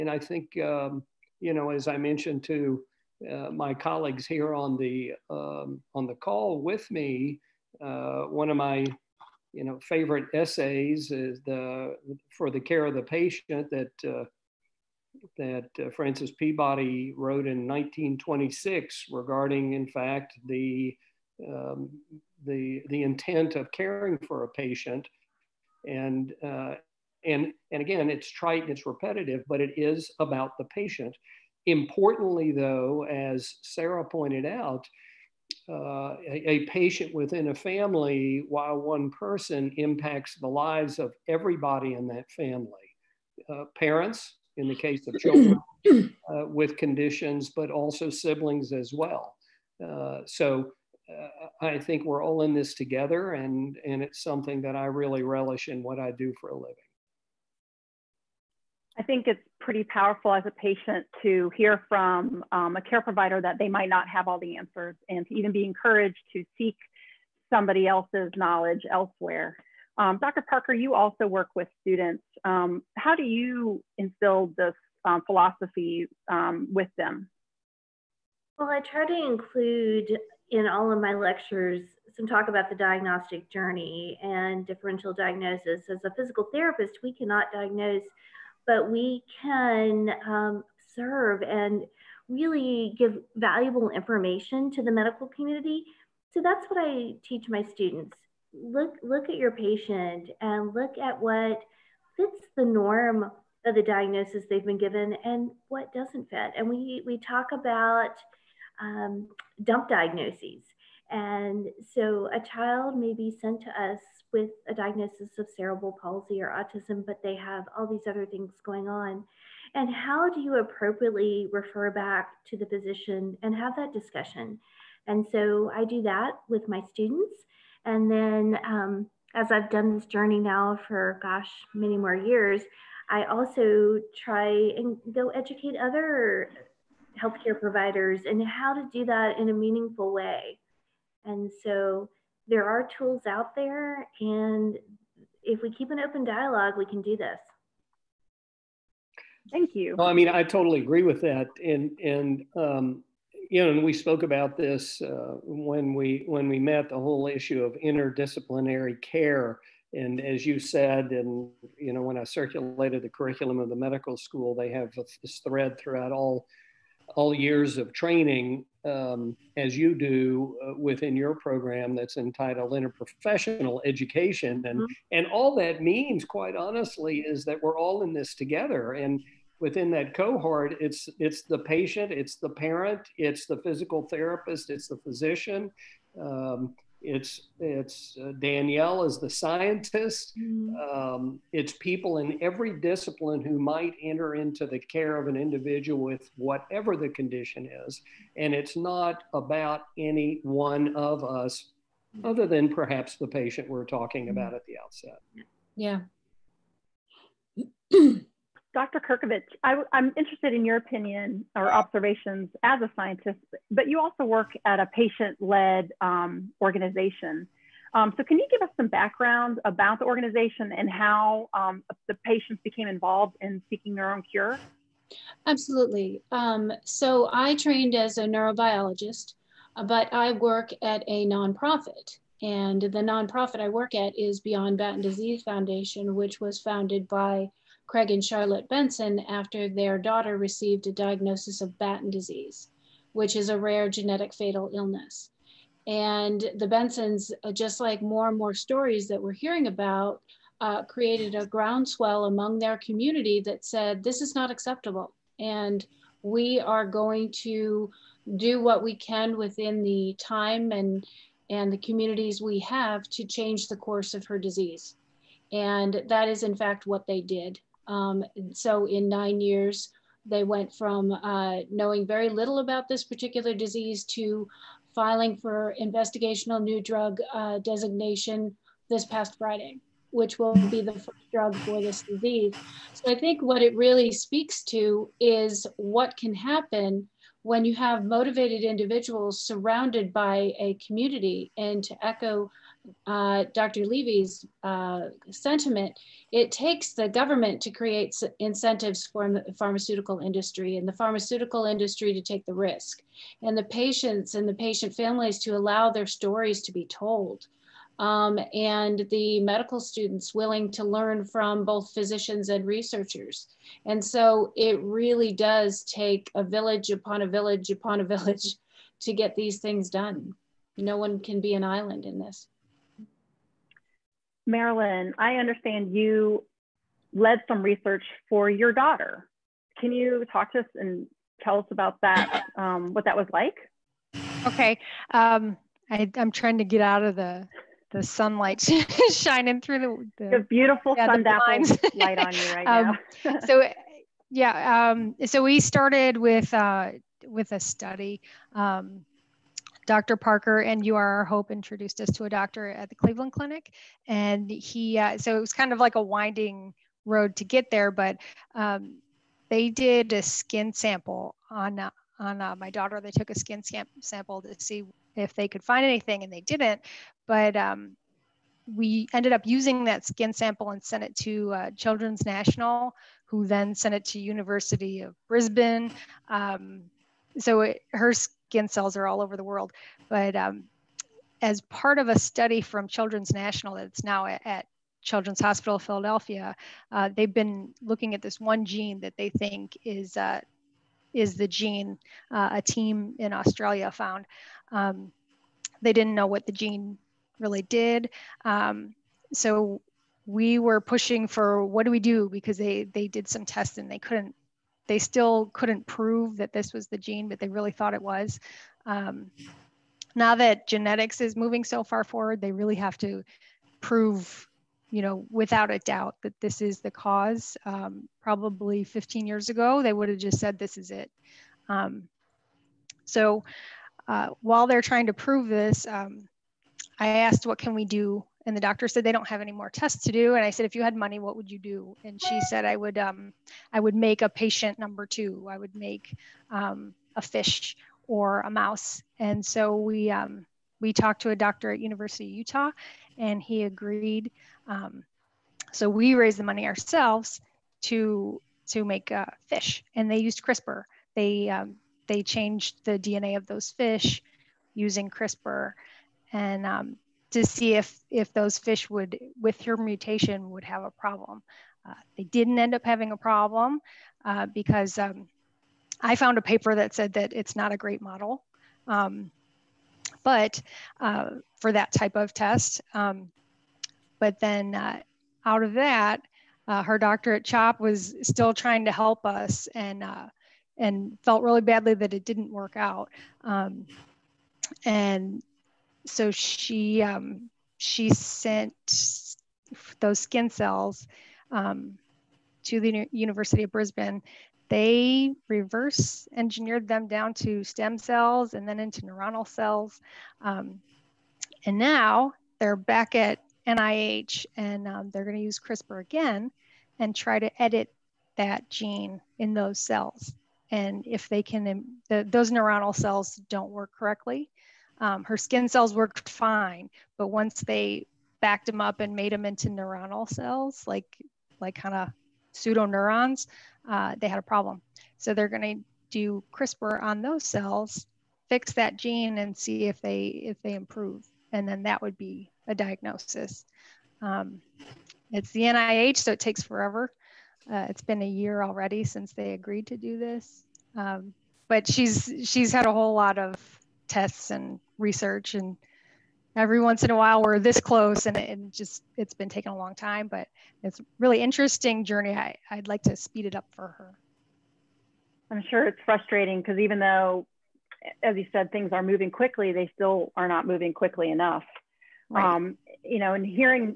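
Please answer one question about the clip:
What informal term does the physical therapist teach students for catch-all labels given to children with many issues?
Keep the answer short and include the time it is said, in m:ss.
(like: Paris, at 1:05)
dump diagnoses, at 1:49.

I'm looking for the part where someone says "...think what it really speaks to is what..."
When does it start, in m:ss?
4:43.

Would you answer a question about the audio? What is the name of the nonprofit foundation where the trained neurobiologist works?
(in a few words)
Beyond Batten Disease Foundation.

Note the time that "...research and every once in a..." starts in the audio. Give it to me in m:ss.
9:04.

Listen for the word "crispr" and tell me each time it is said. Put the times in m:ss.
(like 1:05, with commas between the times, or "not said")
7:30, 7:35, 8:25, 8:46.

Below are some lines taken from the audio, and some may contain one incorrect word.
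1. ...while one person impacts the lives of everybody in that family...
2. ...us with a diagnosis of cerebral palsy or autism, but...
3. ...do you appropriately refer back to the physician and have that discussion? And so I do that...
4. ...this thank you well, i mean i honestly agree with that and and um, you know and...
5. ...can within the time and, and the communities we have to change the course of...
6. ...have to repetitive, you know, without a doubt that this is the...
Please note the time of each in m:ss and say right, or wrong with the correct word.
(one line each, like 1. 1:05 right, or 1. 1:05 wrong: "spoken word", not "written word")
1. 0:38 right
2. 1:53 right
3. 2:00 right
4. 2:27 wrong: "totally", not "honestly"
5. 4:18 right
6. 6:52 wrong: "prove", not "repetitive".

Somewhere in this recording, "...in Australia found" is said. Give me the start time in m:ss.
6:33.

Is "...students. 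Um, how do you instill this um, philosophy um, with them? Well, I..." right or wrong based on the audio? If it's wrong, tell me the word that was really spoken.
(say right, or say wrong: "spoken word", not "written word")
right.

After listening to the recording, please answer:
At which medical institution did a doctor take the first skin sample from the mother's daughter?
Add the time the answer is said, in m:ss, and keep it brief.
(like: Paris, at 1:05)
Cleveland Clinic, at 5:52.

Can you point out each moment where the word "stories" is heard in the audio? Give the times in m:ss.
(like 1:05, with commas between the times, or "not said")
4:08, 5:06.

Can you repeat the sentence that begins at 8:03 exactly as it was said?
Um, and so she um, she sent those skin cells um, to the University of Brisbane.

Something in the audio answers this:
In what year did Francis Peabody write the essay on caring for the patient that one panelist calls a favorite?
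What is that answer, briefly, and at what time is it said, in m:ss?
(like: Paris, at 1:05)
1926, at 0:17.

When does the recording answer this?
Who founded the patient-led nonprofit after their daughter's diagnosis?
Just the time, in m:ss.
3:57.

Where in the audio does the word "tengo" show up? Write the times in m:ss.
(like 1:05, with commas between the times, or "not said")
not said.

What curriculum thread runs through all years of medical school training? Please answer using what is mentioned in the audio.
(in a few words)
interprofessional education.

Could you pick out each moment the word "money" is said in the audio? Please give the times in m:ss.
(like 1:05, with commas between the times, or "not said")
7:10, 7:26.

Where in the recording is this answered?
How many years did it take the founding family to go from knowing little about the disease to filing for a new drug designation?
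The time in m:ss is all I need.
4:29.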